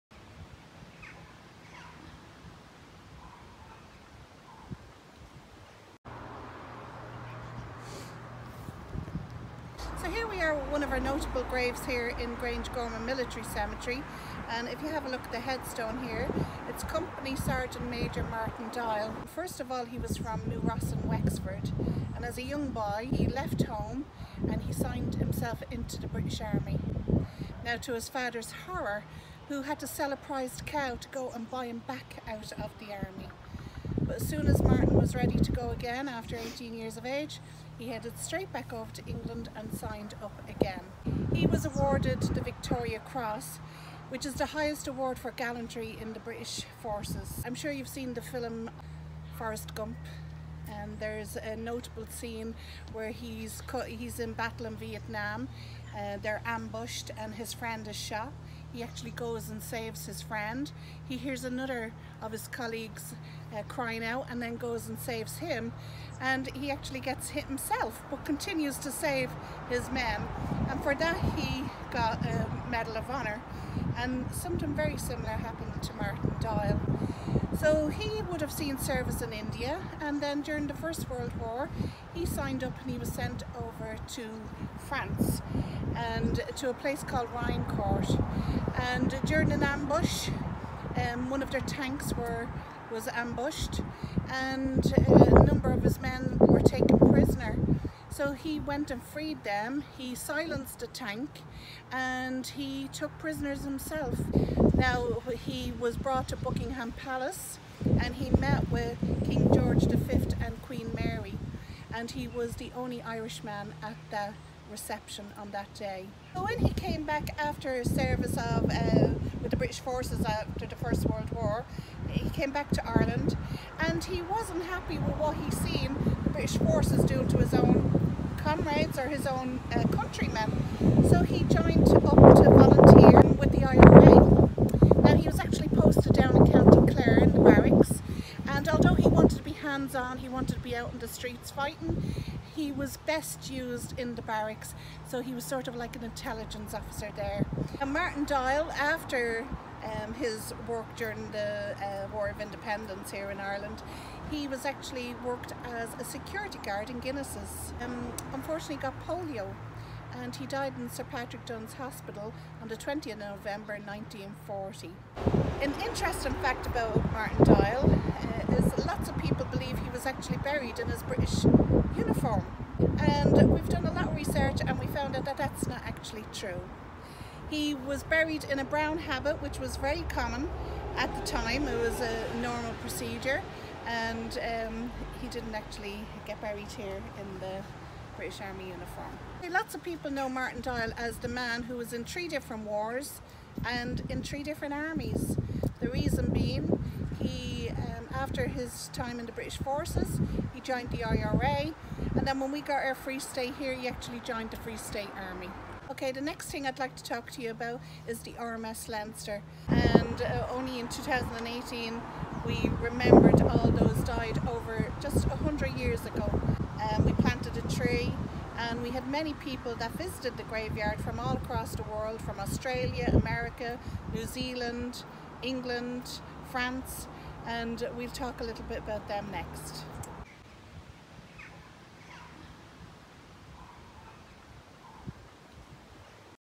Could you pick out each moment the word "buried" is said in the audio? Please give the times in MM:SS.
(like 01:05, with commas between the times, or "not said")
02:50, 02:58, 03:06.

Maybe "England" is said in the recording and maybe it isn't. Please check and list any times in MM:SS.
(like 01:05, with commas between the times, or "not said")
00:39, 03:45.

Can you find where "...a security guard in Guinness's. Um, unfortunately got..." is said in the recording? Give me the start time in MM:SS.
02:35.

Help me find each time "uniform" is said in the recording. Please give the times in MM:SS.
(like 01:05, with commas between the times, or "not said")
02:51, 03:08.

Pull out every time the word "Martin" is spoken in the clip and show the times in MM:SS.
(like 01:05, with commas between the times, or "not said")
00:18, 00:34, 01:15, 02:27, 02:47, 03:10.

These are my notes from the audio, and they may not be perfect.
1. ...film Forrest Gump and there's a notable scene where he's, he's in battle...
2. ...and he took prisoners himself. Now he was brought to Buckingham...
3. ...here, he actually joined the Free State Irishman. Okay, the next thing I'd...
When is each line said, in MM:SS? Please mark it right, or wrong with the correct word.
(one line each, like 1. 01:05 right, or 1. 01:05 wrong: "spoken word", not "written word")
1. 00:48 right
2. 01:41 right
3. 03:23 wrong: "Army", not "Irishman".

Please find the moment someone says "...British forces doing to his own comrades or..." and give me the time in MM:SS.
02:06.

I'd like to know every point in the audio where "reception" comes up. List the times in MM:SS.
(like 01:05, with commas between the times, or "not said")
01:54.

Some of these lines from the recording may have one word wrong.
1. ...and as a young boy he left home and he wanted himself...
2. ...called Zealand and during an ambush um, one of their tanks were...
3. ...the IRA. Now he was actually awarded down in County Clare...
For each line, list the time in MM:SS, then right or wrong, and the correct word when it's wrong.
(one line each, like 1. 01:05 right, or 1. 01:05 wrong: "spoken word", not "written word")
1. 00:22 wrong: "signed", not "wanted"
2. 01:27 wrong: "Riencourt", not "Zealand"
3. 02:13 wrong: "posted", not "awarded".